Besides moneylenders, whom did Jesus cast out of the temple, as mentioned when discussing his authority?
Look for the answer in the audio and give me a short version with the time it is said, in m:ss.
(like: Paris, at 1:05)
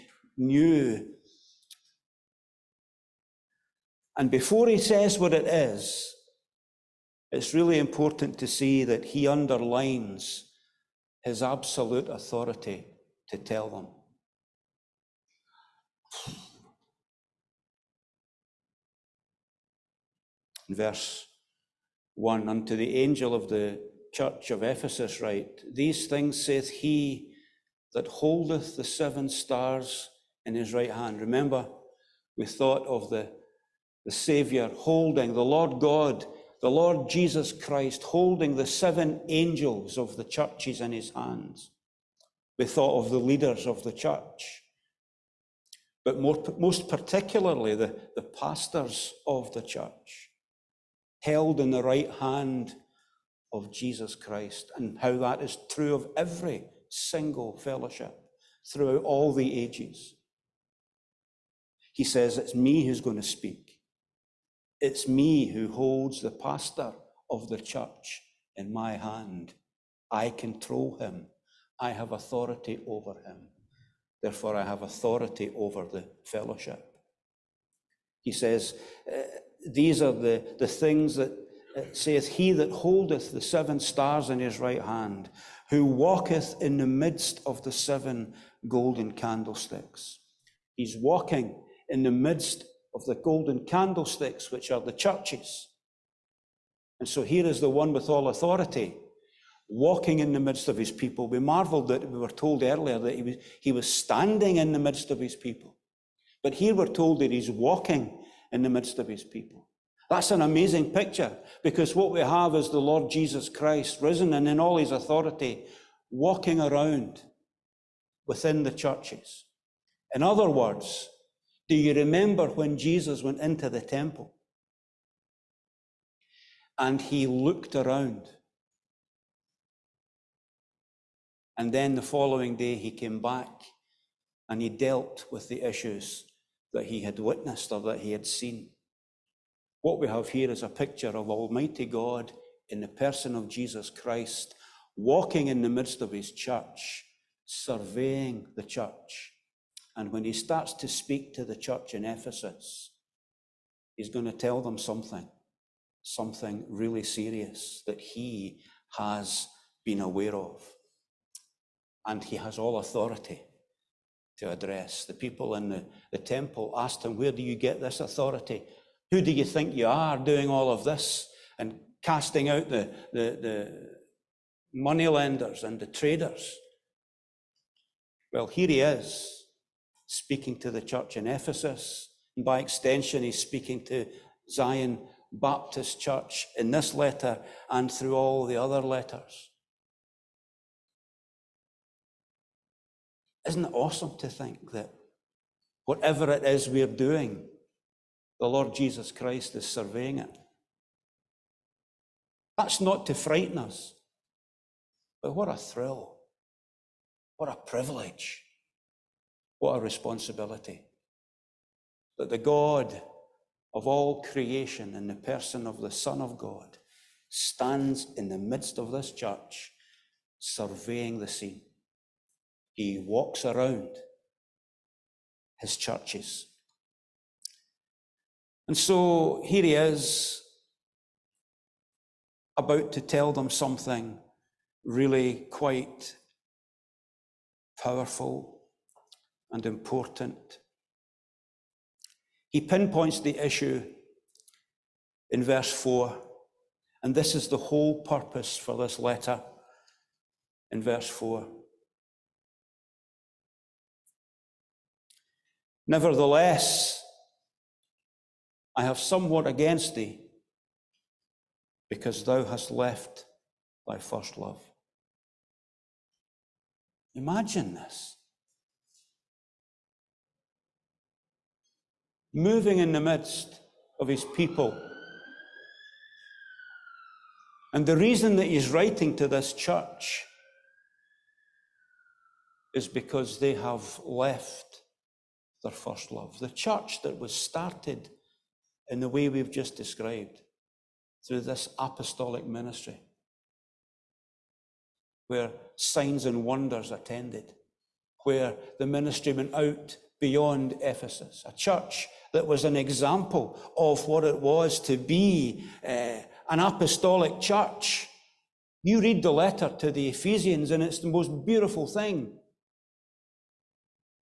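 traders, at 2:55.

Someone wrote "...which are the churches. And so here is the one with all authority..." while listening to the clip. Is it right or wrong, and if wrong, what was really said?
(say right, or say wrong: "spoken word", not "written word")
right.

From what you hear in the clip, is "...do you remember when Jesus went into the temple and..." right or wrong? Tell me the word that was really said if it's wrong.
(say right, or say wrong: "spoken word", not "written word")
right.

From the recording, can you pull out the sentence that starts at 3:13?
Isn't it awesome to think that whatever it is we're doing, the Lord Jesus Christ is surveying it?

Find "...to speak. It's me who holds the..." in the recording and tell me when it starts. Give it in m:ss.
1:03.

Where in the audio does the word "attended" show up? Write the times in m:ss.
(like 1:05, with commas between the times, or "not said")
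4:56.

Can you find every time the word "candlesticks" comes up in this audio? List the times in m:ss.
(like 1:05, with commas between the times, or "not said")
1:29, 1:33.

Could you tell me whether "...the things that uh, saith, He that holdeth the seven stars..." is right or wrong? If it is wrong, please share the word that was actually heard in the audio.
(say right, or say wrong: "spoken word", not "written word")
right.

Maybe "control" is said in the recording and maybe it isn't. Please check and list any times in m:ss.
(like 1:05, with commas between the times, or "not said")
1:10.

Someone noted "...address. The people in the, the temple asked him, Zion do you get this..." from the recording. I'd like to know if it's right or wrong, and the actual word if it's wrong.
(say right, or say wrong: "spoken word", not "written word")
wrong: "Where", not "Zion".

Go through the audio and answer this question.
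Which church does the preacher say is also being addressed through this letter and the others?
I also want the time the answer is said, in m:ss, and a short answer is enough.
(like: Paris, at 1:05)
Zion Baptist Church, at 3:04.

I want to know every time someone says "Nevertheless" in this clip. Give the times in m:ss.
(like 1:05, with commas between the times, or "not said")
4:15.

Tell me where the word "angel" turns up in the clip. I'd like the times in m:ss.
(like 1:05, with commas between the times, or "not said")
0:22, 0:39.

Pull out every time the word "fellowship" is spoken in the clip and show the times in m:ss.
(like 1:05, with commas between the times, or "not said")
0:57, 1:16.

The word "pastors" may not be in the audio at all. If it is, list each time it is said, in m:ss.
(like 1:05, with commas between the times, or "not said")
0:48, 1:06.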